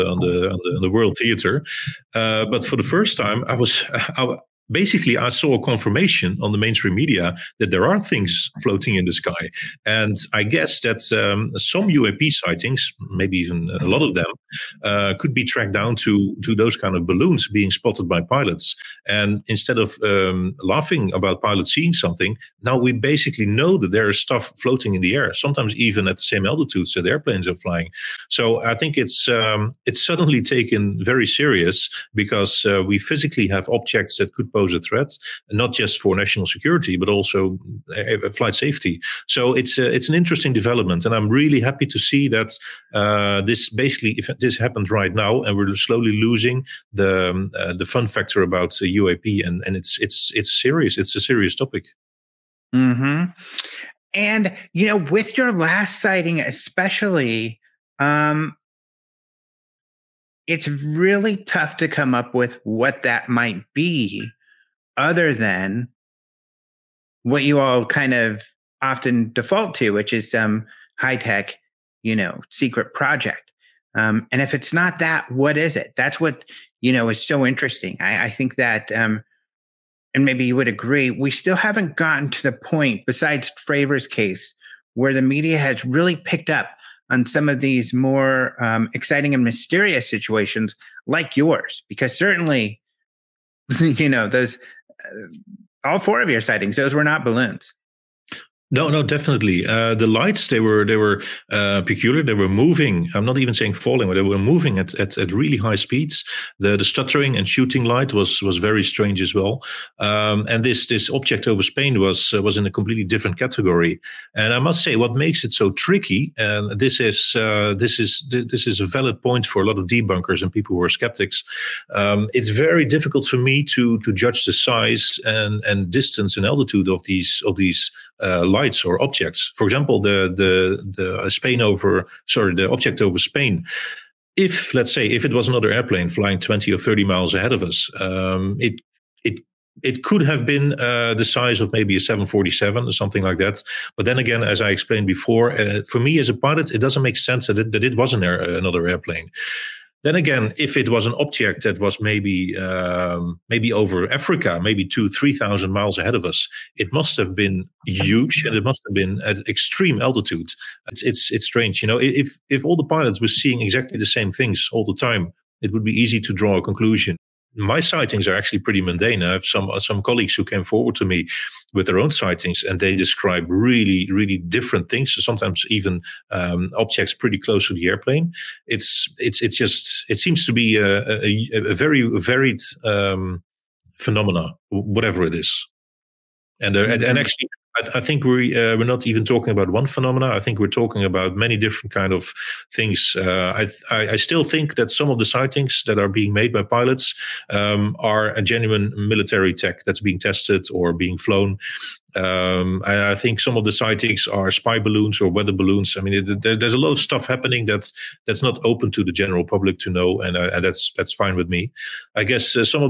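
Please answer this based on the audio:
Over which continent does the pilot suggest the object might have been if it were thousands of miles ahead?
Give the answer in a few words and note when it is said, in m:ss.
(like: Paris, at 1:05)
Africa, at 2:34.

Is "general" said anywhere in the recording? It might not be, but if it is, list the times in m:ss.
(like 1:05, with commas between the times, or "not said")
3:29.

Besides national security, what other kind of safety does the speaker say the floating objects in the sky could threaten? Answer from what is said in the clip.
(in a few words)
flight safety.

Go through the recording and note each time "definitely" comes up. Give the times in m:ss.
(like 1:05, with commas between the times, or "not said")
1:39.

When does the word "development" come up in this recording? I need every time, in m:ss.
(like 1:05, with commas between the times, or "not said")
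0:40.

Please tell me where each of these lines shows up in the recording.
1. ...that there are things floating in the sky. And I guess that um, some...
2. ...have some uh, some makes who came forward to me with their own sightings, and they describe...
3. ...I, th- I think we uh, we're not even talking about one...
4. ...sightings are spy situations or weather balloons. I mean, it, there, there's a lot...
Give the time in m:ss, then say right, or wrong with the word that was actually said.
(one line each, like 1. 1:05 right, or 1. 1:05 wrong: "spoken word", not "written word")
1. 0:07 right
2. 2:49 wrong: "colleagues", not "makes"
3. 3:07 right
4. 3:23 wrong: "balloons", not "situations".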